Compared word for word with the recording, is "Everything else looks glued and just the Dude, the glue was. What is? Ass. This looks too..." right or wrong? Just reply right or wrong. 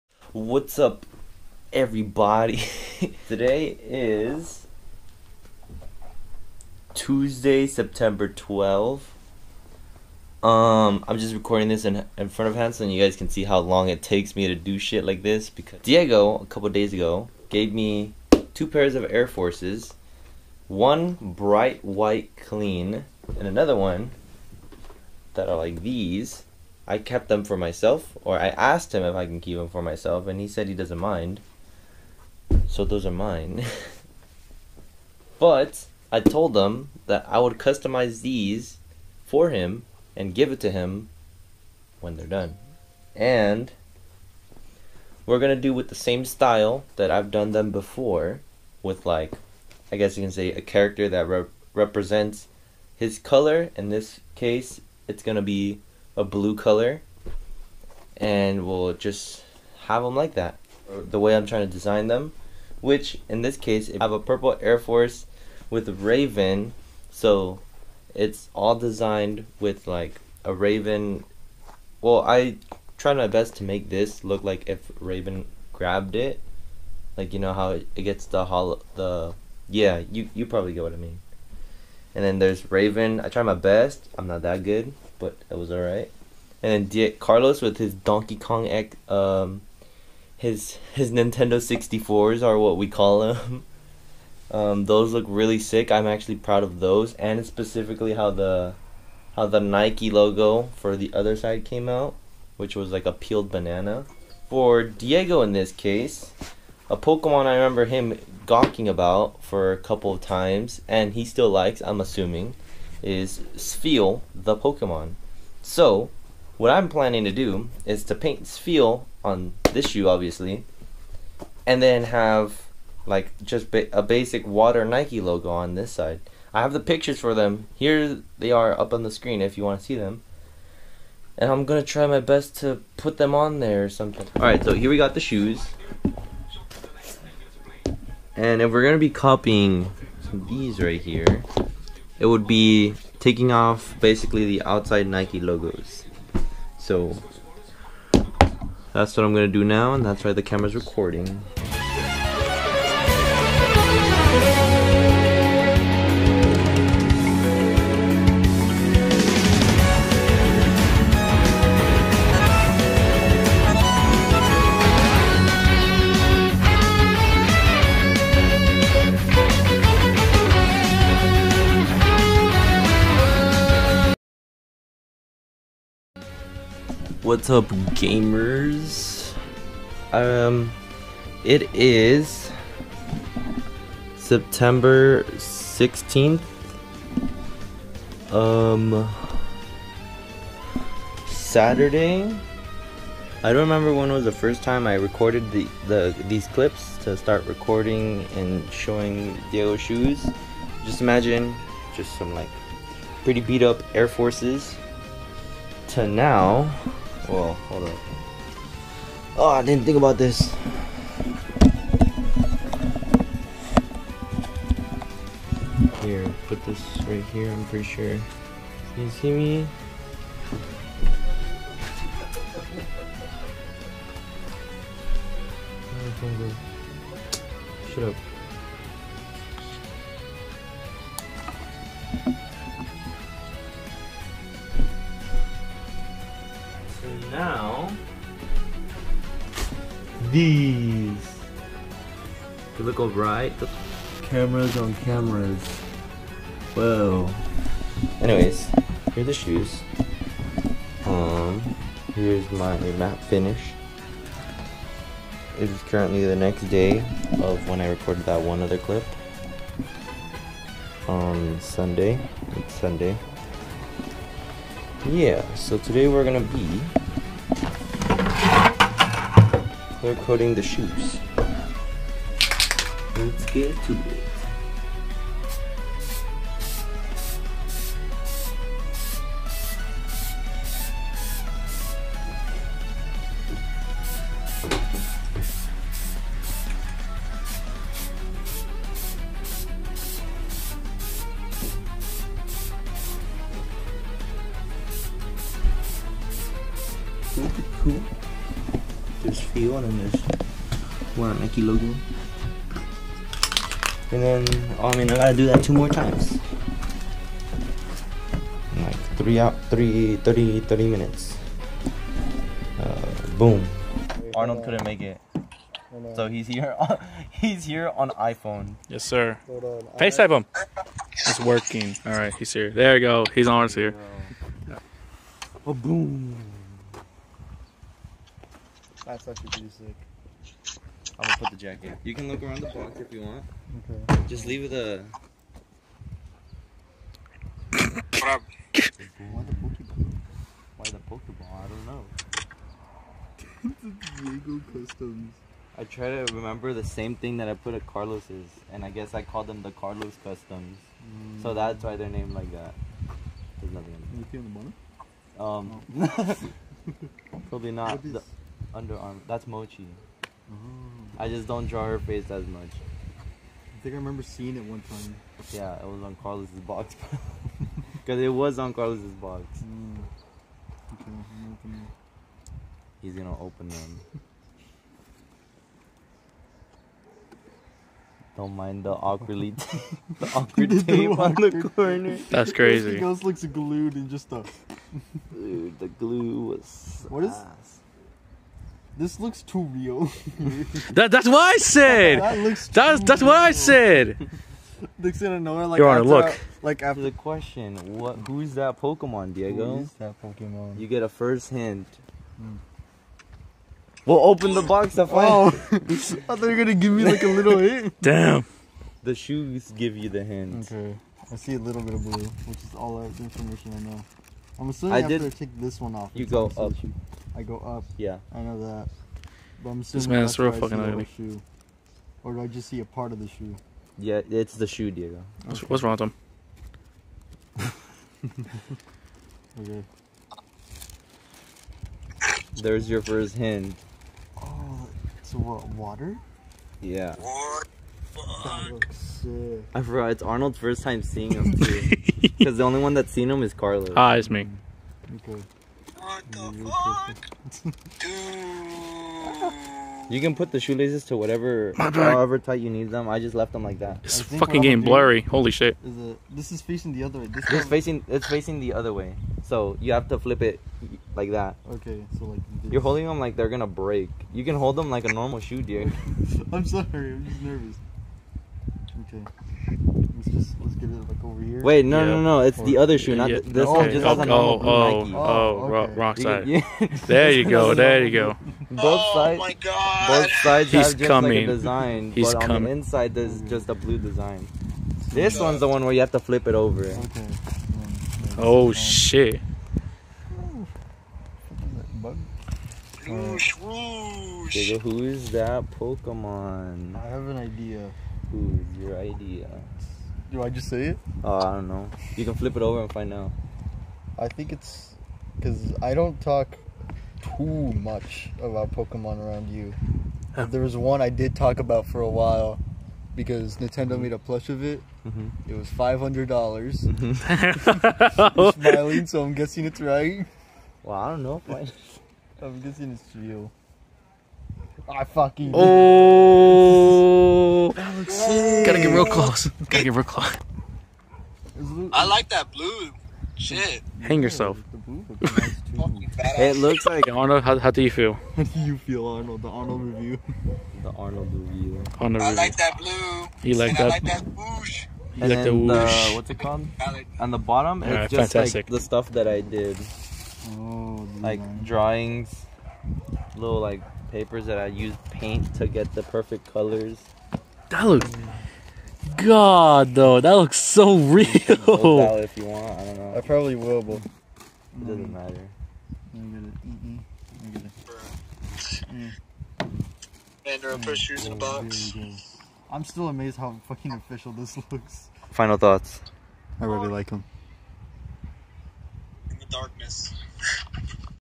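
right.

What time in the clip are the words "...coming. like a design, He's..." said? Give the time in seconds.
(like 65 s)
481 s.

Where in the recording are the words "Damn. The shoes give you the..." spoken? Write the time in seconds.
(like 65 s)
408 s.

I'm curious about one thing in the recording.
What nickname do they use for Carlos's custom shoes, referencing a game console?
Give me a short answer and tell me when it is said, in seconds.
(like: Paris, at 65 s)
Nintendo 64s, at 91 s.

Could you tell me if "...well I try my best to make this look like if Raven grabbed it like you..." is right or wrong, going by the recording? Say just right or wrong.
right.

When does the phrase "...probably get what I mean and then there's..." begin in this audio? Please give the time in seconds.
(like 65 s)
80 s.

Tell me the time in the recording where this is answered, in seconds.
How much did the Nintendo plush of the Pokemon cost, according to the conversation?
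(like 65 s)
515 s.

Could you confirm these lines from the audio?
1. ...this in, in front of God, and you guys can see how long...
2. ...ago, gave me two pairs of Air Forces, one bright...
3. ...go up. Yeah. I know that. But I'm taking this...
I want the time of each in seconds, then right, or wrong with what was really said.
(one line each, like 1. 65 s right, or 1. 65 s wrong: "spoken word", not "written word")
1. 11 s wrong: "Hansel", not "God"
2. 16 s right
3. 417 s wrong: "assuming", not "taking".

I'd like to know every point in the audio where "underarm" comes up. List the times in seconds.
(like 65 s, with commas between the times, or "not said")
358 s.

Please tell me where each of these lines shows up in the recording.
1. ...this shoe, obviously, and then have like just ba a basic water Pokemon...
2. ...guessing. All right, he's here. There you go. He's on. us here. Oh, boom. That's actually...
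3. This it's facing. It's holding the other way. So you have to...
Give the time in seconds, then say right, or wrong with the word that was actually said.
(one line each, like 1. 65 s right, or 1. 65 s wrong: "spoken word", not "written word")
1. 119 s wrong: "Nike", not "Pokemon"
2. 321 s wrong: "working", not "guessing"
3. 457 s wrong: "facing", not "holding".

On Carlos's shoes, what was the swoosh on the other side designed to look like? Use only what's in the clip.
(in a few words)
a peeled banana.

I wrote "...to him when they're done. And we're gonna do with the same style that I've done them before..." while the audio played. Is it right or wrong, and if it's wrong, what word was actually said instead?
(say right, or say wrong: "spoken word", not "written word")
right.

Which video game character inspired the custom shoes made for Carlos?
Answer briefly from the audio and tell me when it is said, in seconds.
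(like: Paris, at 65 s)
Donkey Kong, at 87 s.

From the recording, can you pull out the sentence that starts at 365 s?
Yeah, it was on Carlos's box.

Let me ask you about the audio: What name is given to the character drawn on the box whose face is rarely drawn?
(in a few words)
Mochi.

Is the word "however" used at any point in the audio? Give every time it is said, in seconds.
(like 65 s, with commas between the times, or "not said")
451 s.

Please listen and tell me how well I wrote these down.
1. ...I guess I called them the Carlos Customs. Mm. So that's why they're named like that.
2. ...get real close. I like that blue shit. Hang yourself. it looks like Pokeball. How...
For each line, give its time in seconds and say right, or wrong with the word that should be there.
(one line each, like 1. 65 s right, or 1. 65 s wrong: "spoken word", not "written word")
1. 348 s right
2. 529 s wrong: "Arnold", not "Pokeball".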